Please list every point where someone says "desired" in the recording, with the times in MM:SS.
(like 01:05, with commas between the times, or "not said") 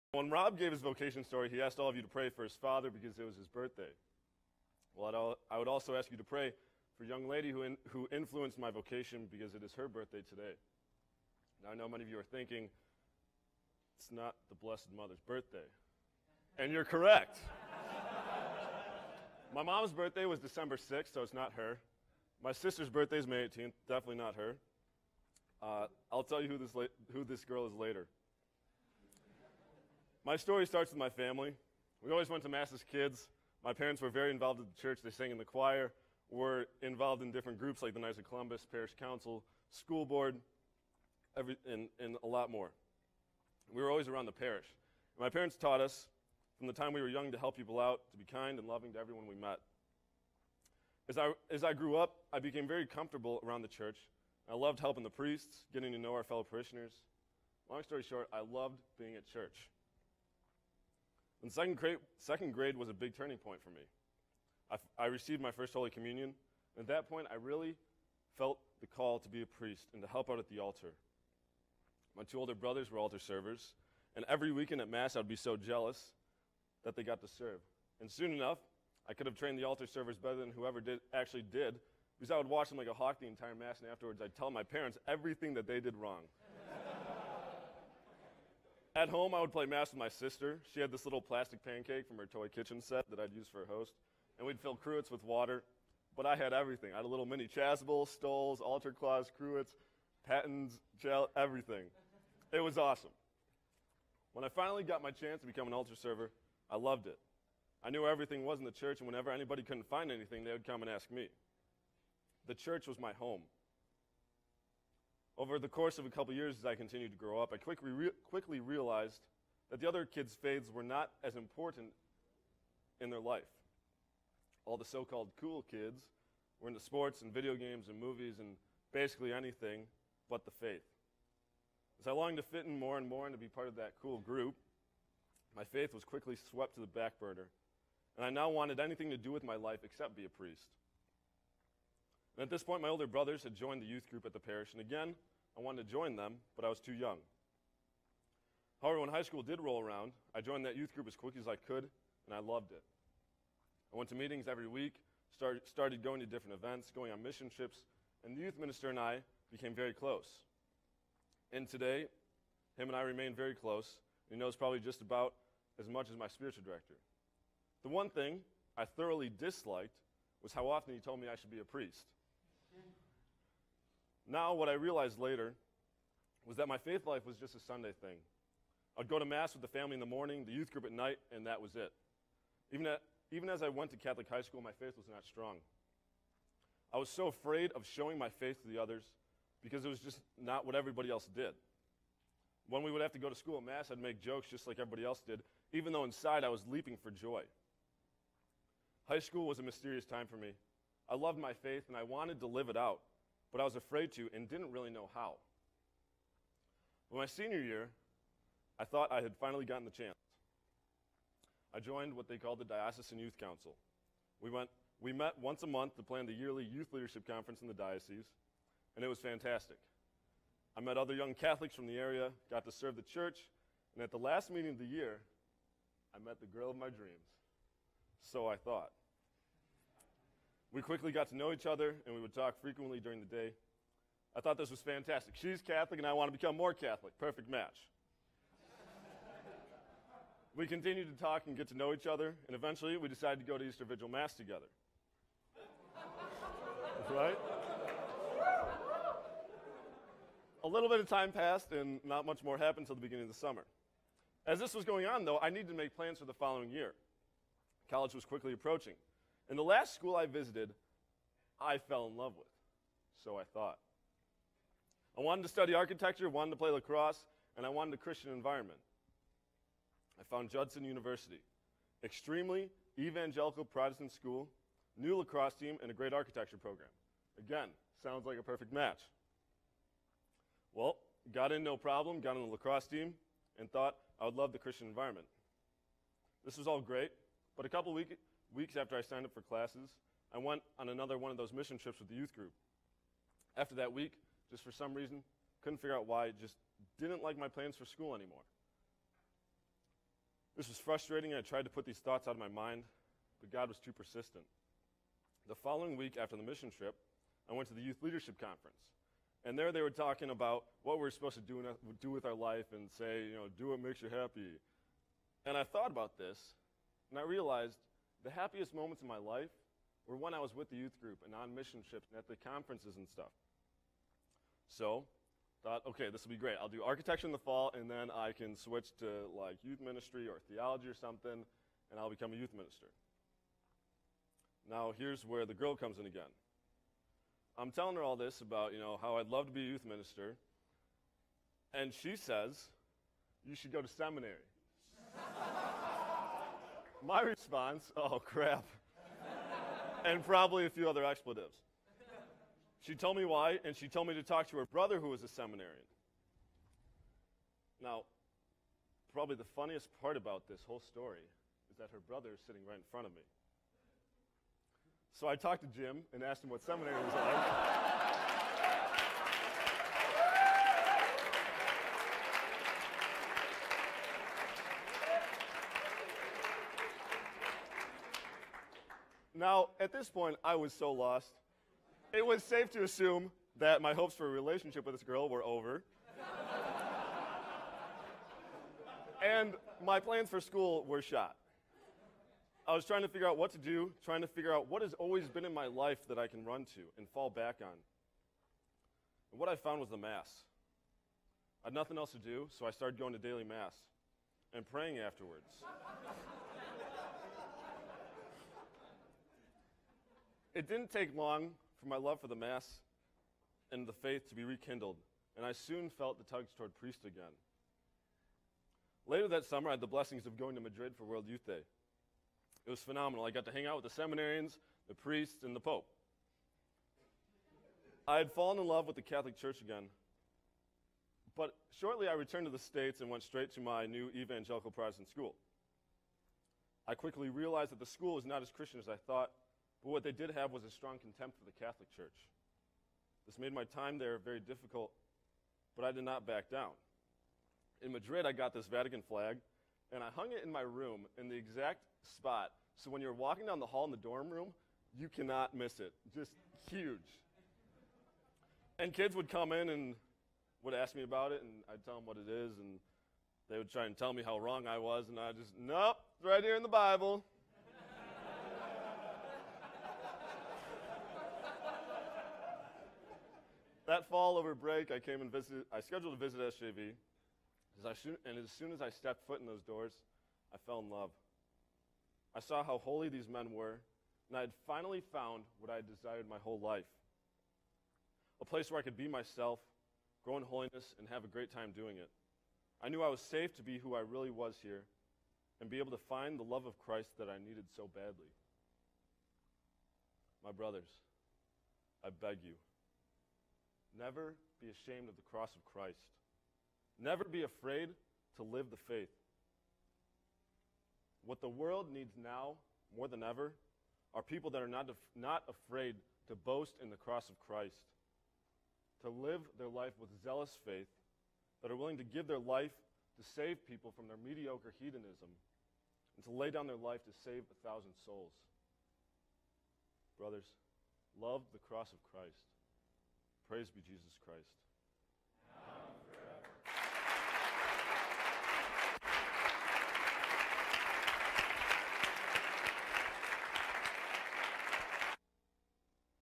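08:05.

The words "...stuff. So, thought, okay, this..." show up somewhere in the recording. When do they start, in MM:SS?
05:23.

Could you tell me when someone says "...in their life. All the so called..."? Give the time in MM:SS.
02:02.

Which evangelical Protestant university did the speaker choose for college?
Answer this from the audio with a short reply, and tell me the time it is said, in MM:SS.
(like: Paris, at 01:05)
Judson University, at 04:30.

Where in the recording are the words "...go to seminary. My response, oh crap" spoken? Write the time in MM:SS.
05:43.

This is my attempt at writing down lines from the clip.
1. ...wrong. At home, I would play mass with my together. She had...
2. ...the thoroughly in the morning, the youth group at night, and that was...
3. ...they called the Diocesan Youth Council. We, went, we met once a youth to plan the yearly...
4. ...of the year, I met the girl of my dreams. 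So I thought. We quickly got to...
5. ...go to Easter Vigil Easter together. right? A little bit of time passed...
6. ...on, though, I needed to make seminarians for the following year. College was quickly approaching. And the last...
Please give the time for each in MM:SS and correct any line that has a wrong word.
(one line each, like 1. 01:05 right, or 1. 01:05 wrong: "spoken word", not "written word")
1. 01:25 wrong: "sister", not "together"
2. 02:59 wrong: "family", not "thoroughly"
3. 03:32 wrong: "month", not "youth"
4. 03:44 right
5. 04:03 wrong: "Mass", not "Easter"
6. 04:15 wrong: "plans", not "seminarians".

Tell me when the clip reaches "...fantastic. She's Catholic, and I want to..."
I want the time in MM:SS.
03:54.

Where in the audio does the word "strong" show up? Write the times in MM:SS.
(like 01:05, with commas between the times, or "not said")
03:05, 07:20.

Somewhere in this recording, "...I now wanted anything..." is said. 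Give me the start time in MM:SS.
02:18.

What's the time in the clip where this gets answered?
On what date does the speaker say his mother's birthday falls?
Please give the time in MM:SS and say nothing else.
00:20.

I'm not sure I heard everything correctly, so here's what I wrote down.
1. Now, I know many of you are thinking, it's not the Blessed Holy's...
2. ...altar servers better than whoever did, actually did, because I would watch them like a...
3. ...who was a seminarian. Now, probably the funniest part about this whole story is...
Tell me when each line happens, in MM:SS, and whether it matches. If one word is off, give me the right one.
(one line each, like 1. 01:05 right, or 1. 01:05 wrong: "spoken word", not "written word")
1. 00:11 wrong: "Mother", not "Holy"
2. 01:19 right
3. 05:54 right.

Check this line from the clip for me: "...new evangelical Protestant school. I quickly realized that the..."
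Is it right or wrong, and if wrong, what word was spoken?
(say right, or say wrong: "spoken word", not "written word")
right.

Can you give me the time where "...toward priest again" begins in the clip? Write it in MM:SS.
06:56.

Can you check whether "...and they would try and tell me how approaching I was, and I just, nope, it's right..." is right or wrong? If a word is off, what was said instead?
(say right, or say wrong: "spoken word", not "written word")
wrong: "wrong", not "approaching".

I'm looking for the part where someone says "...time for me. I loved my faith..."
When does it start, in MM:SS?
03:20.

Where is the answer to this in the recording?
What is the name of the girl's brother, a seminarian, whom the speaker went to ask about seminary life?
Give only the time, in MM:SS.
06:05.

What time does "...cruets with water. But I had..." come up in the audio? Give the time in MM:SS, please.
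01:34.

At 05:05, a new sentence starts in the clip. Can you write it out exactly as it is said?
The following week after the mission trip, I went to the Youth Leadership Conference.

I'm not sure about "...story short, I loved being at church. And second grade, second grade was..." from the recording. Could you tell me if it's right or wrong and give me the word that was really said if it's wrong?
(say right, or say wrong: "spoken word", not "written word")
right.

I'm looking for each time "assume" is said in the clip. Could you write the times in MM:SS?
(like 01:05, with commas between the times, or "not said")
06:22.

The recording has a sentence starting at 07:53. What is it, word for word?
that fall over break, I came and visited, I scheduled a visit SJV.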